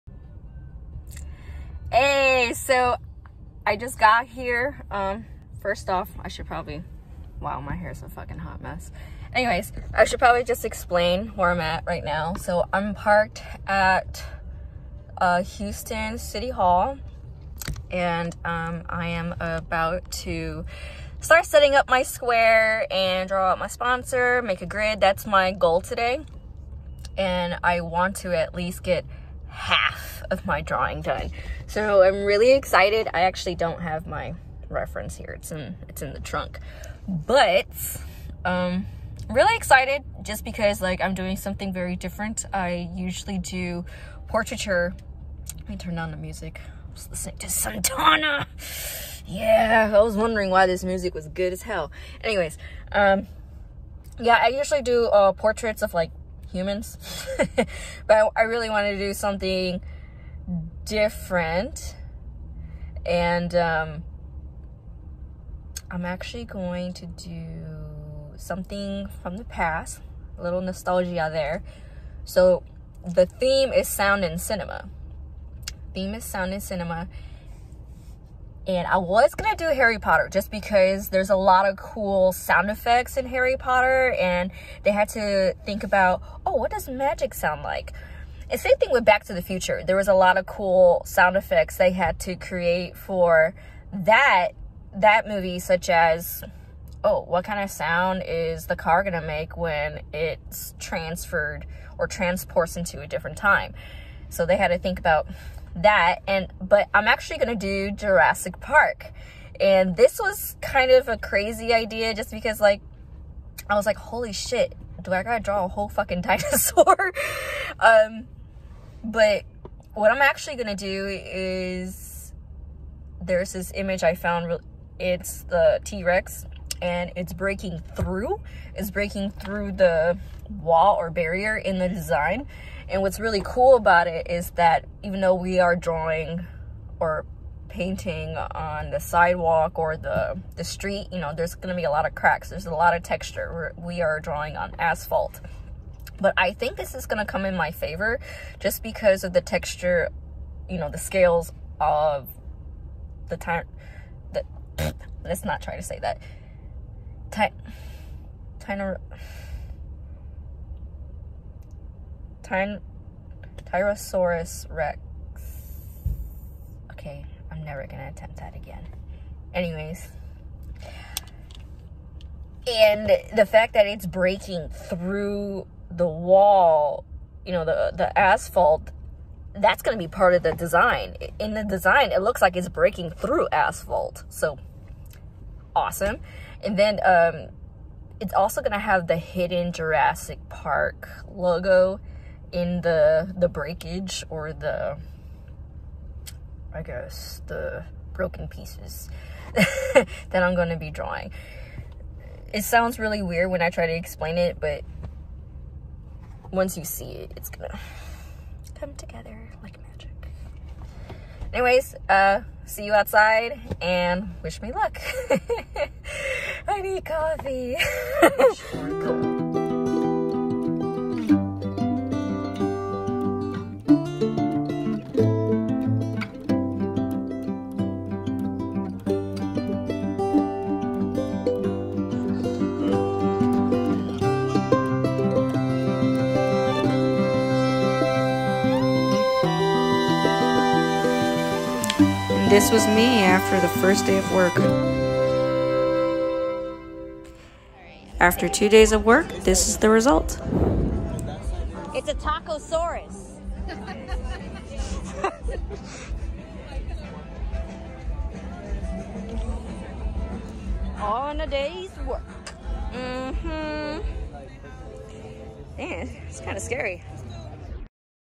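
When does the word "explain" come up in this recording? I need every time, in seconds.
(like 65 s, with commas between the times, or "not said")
10 s, 203 s.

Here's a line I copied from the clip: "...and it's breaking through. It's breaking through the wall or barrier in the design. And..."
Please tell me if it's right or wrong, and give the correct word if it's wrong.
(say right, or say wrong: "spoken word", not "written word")
right.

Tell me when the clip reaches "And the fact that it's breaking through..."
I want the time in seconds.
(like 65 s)
172 s.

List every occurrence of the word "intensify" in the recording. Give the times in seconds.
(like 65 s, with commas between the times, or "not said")
not said.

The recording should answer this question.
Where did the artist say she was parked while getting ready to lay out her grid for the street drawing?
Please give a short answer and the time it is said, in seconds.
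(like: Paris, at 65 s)
Houston City Hall, at 15 s.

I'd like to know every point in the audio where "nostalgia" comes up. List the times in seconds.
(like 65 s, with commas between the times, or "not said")
70 s.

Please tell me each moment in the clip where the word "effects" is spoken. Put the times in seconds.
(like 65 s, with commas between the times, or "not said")
82 s, 91 s.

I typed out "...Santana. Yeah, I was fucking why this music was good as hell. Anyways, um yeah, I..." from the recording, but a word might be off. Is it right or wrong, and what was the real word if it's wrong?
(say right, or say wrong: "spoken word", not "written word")
wrong: "wondering", not "fucking".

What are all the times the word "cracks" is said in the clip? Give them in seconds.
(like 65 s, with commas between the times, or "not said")
142 s.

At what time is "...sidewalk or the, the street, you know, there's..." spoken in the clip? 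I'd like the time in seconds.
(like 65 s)
138 s.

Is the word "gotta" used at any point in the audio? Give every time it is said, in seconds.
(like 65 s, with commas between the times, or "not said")
115 s.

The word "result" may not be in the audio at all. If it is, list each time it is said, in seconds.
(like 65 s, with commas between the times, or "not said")
249 s.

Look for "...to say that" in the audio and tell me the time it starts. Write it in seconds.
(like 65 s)
155 s.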